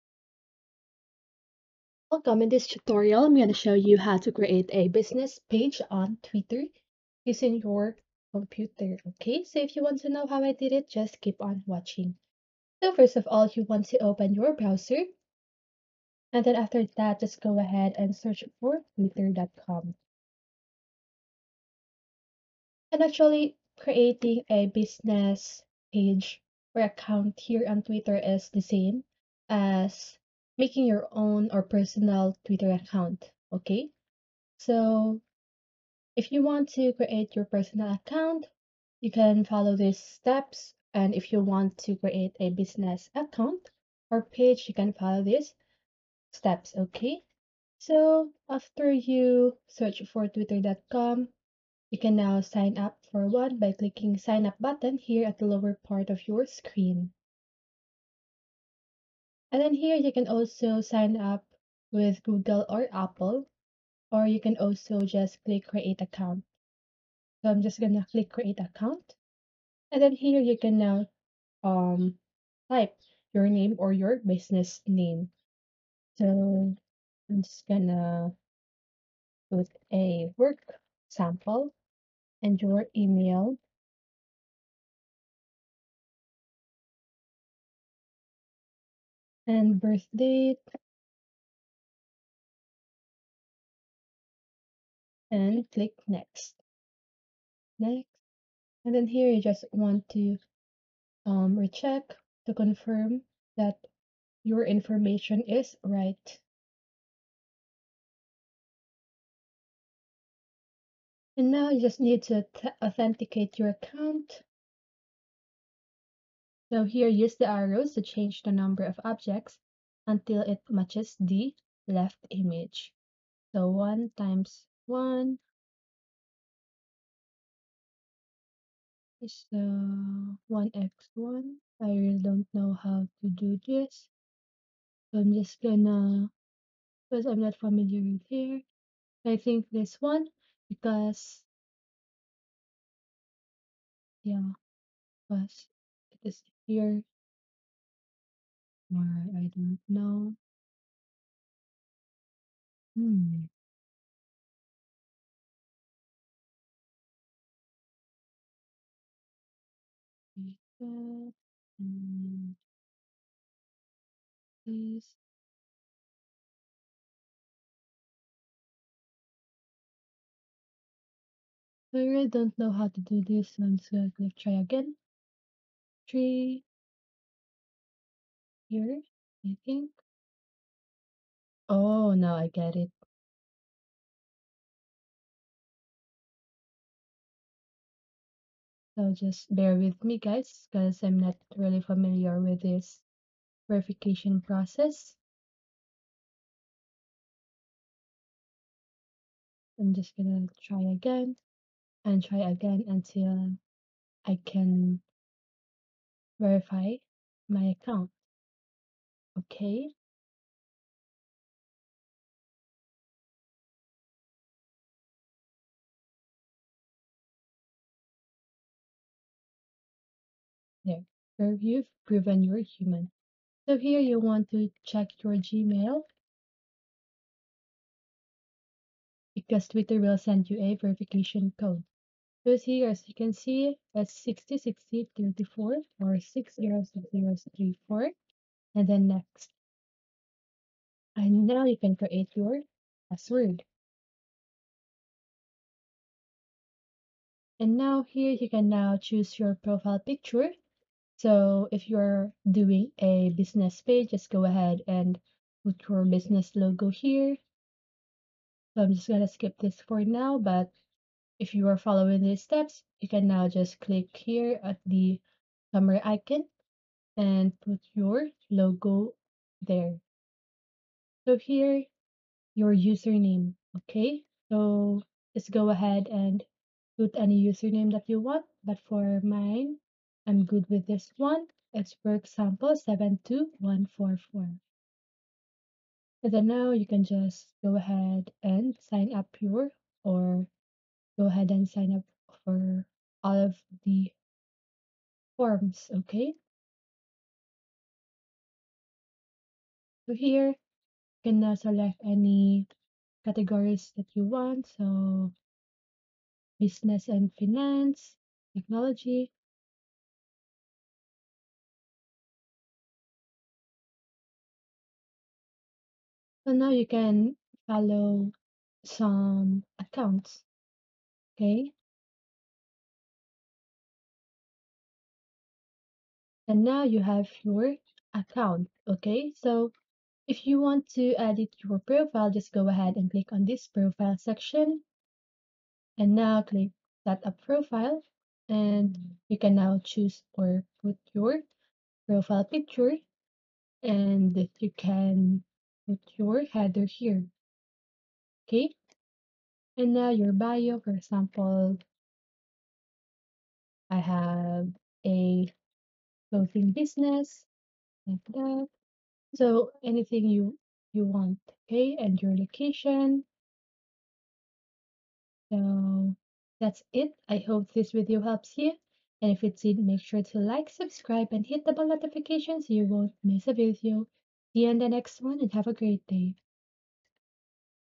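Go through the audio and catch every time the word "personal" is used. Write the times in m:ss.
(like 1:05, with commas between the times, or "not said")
0:31, 0:37.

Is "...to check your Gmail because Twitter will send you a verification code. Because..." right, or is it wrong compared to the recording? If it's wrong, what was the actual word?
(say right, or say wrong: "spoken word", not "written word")
right.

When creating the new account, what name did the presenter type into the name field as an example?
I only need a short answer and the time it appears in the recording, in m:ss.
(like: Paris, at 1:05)
work sample, at 1:20.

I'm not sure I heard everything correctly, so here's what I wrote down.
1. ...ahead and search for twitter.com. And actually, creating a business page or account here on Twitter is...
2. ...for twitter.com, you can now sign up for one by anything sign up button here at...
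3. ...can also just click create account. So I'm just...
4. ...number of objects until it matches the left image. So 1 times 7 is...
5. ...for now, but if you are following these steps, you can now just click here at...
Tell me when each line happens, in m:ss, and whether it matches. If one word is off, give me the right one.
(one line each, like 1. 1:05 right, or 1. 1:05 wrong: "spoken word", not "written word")
1. 0:17 right
2. 0:50 wrong: "clicking", not "anything"
3. 1:04 right
4. 1:58 wrong: "1", not "7"
5. 4:19 right.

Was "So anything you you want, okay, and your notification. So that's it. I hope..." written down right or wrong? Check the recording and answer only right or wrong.
wrong.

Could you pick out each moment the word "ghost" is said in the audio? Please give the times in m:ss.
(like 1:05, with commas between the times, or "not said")
not said.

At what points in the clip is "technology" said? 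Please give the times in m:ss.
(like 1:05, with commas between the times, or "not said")
5:08.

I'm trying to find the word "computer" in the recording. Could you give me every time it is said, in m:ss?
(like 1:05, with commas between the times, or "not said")
0:08.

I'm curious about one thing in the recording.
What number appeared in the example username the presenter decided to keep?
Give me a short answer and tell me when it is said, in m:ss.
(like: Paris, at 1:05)
72144, at 4:42.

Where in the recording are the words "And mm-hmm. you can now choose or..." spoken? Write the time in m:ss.
5:38.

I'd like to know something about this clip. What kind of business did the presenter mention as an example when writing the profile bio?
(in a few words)
clothing business.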